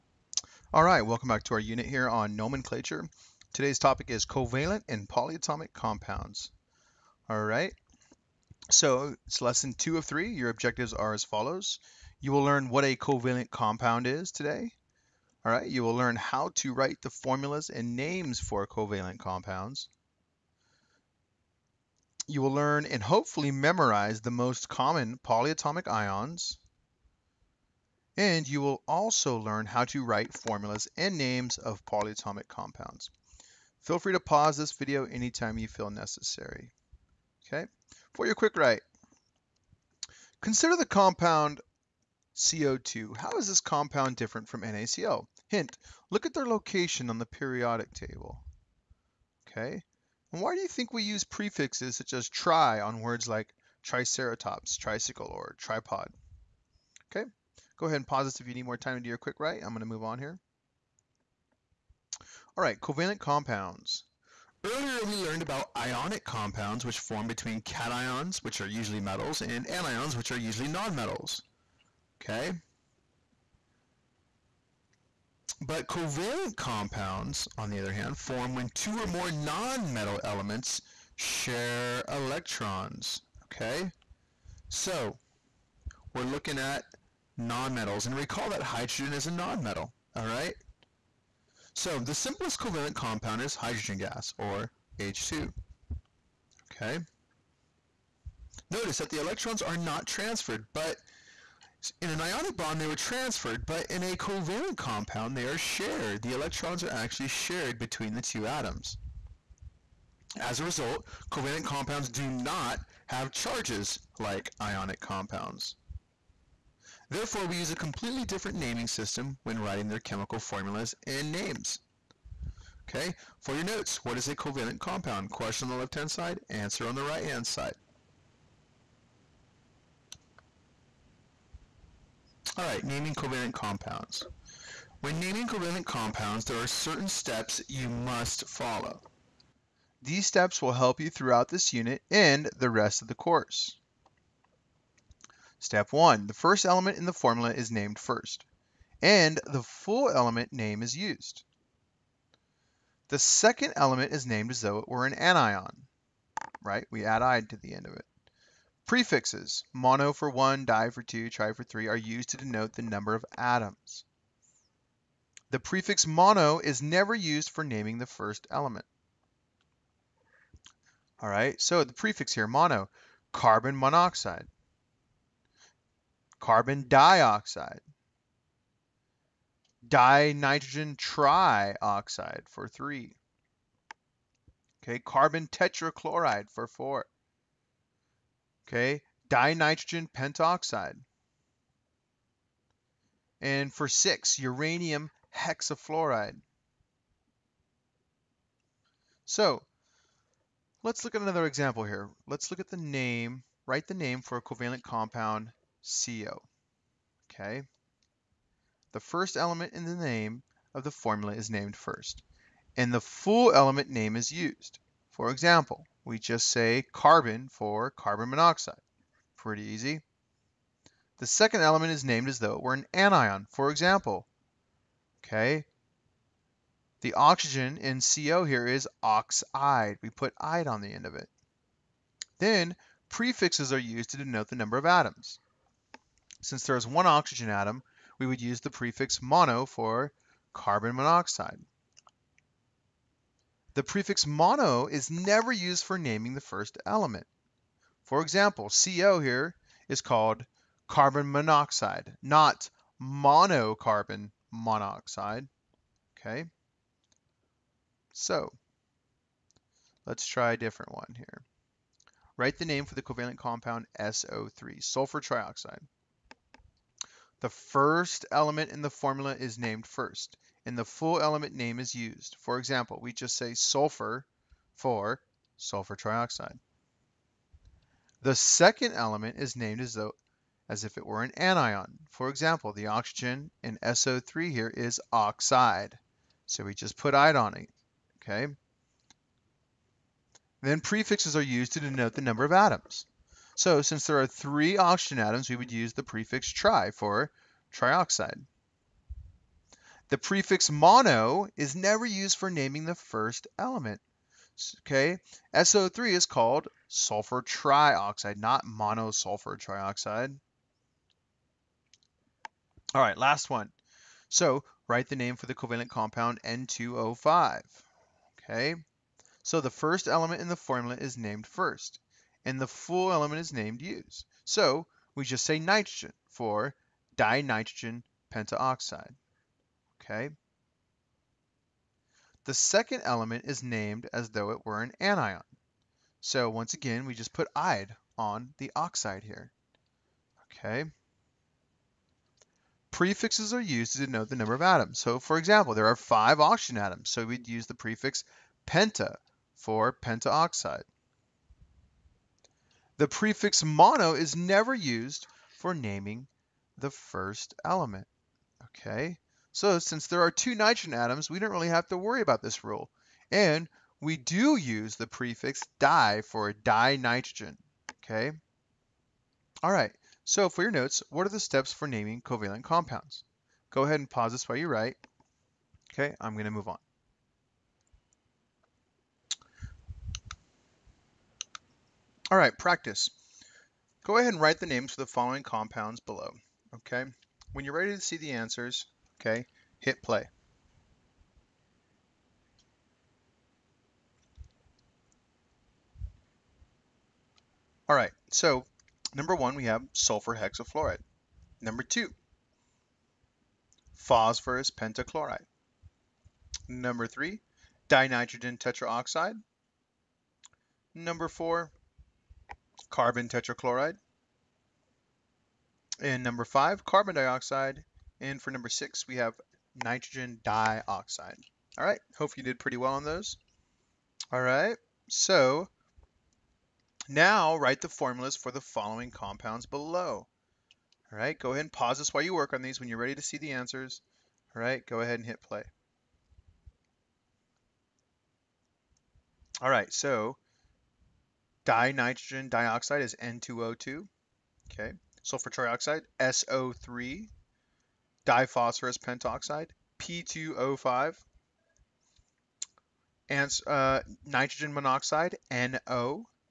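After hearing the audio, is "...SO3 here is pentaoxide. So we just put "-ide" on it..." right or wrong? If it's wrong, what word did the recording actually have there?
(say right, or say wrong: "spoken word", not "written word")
wrong: "oxide", not "pentaoxide".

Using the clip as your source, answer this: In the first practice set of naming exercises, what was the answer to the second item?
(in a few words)
phosphorus pentachloride.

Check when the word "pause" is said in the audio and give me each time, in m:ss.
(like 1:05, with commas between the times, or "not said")
0:34, 0:58, 6:14, 7:11.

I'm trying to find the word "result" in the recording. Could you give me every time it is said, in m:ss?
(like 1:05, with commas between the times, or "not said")
1:50.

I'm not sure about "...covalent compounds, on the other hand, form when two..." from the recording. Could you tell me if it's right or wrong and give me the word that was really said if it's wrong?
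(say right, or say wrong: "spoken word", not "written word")
right.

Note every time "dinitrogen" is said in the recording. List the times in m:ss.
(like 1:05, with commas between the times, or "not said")
2:59, 3:09, 5:27, 6:06, 6:47, 7:21.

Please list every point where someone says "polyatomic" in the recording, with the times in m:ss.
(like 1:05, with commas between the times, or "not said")
0:05, 0:25, 0:31.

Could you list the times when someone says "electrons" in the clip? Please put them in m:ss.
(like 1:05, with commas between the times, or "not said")
1:22, 1:39, 1:46.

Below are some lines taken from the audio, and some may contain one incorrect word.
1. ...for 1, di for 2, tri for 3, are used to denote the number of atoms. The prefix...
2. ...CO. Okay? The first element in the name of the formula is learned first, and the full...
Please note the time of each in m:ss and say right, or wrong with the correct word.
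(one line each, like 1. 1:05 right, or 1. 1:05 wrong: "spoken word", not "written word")
1. 2:40 right
2. 3:25 wrong: "named", not "learned".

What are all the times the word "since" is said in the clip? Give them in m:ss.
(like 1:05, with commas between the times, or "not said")
3:56, 4:53, 5:59.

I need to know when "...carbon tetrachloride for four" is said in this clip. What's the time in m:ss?
3:04.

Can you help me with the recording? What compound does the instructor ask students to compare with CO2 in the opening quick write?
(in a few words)
NaCl.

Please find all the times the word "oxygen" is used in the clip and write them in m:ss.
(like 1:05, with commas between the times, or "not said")
3:47, 3:57, 4:42, 4:54, 5:46.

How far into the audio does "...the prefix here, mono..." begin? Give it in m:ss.
2:51.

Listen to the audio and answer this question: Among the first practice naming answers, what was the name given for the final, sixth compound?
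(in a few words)
nitrogen dioxide.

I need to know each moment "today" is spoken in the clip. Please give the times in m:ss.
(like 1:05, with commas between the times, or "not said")
0:03, 0:14.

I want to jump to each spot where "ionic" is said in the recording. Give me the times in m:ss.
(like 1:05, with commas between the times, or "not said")
1:05, 1:42, 1:54.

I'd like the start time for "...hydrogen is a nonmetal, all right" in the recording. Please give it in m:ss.
1:28.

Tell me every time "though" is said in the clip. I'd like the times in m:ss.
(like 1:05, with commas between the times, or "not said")
2:34, 3:42, 4:39, 5:34.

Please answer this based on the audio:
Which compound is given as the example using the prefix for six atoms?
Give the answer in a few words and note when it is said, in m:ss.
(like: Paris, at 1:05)
uranium hexafluoride, at 3:14.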